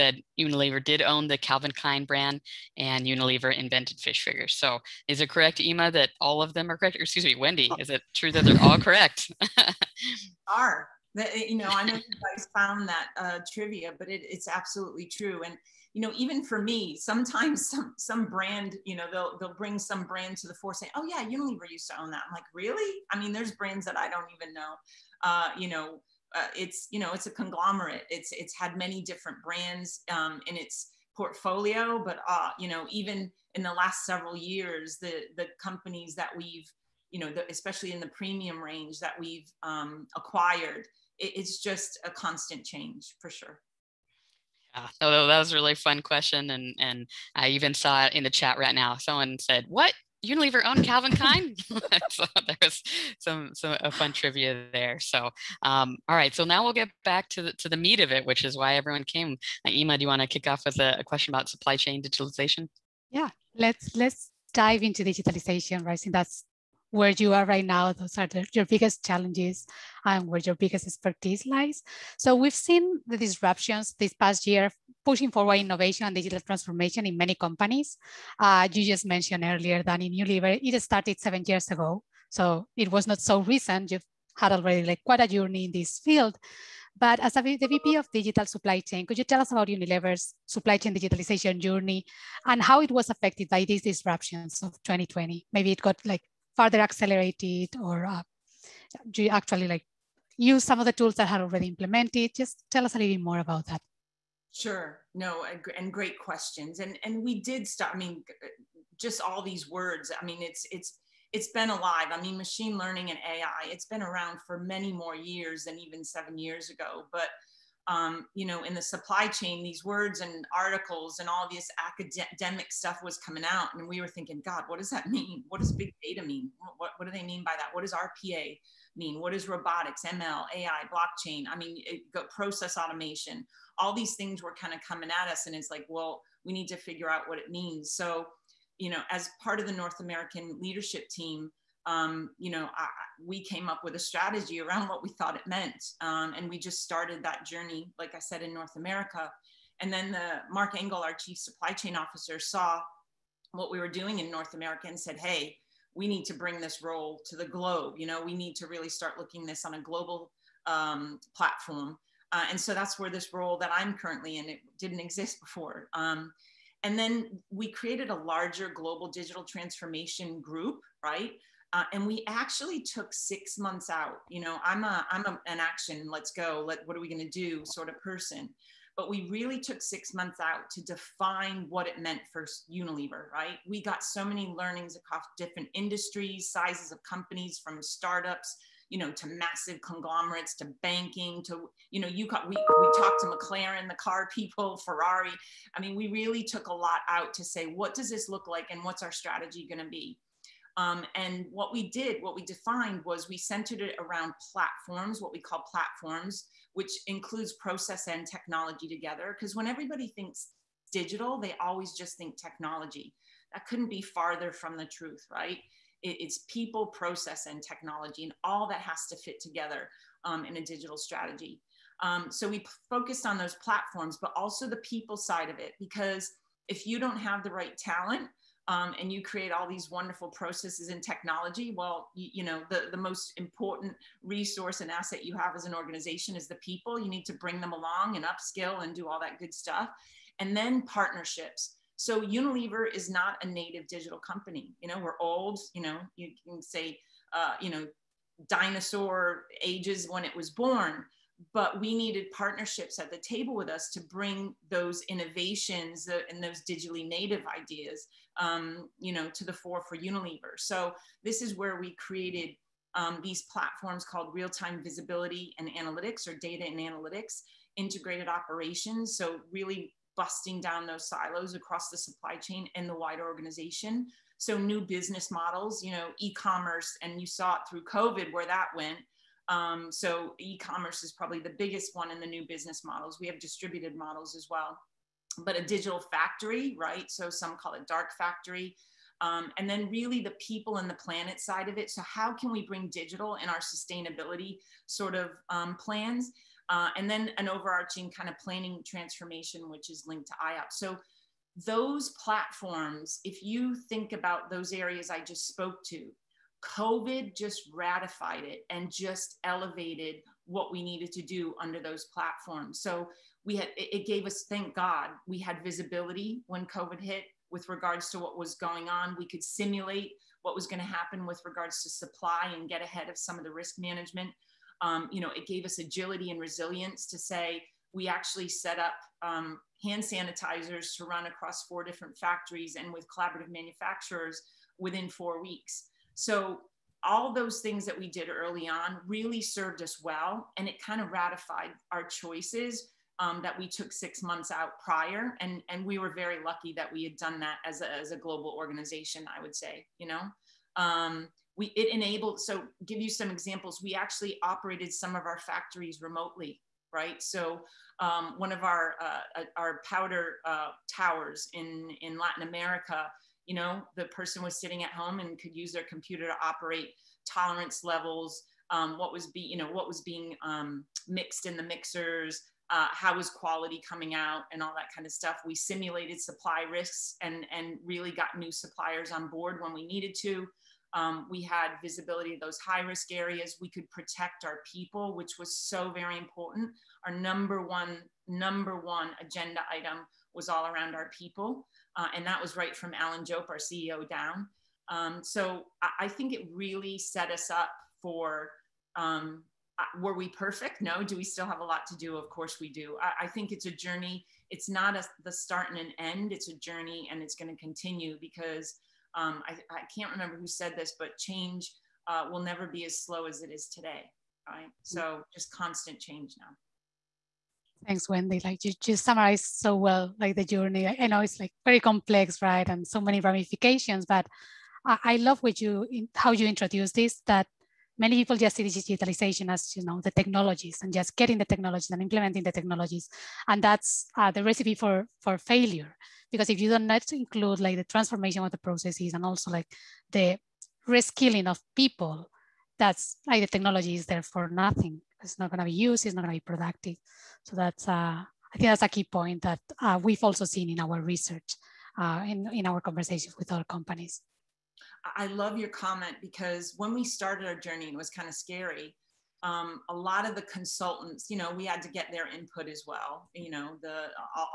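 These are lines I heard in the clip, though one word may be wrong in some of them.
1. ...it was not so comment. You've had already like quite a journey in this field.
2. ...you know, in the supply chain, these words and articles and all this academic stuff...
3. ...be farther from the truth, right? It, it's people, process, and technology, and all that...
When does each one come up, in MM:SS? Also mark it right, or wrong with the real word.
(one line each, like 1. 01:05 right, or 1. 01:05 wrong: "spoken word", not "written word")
1. 01:22 wrong: "recent", not "comment"
2. 01:58 right
3. 03:33 right.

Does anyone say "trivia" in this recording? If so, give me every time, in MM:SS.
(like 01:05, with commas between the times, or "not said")
00:13, 00:54.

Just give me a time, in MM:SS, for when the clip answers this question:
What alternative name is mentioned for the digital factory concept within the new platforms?
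04:47.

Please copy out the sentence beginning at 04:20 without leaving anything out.
So this is where we created um, these platforms called real-time visibility and analytics or data and analytics, integrated operations.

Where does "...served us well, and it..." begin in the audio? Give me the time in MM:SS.
05:39.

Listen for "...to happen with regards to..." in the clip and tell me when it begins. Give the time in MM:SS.
05:20.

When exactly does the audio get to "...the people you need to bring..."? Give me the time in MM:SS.
03:56.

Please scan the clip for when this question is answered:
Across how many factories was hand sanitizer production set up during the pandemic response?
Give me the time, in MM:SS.
05:31.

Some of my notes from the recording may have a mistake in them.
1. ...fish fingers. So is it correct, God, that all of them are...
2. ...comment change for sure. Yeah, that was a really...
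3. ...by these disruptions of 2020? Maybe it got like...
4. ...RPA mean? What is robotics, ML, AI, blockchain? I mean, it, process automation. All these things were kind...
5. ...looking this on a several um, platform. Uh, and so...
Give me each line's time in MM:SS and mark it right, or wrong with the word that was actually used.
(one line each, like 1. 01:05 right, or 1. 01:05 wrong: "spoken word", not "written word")
1. 00:03 wrong: "Emma", not "God"
2. 00:42 wrong: "constant", not "comment"
3. 01:33 right
4. 02:07 right
5. 02:39 wrong: "global", not "several".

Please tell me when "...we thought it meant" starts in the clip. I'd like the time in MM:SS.
02:25.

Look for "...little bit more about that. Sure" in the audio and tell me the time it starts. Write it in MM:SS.
01:42.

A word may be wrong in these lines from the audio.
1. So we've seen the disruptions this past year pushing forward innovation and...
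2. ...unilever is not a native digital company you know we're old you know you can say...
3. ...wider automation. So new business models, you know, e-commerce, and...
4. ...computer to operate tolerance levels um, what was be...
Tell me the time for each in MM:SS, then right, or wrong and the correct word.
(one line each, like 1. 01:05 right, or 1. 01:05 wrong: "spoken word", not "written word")
1. 01:12 right
2. 04:02 right
3. 04:32 wrong: "organization", not "automation"
4. 06:05 right.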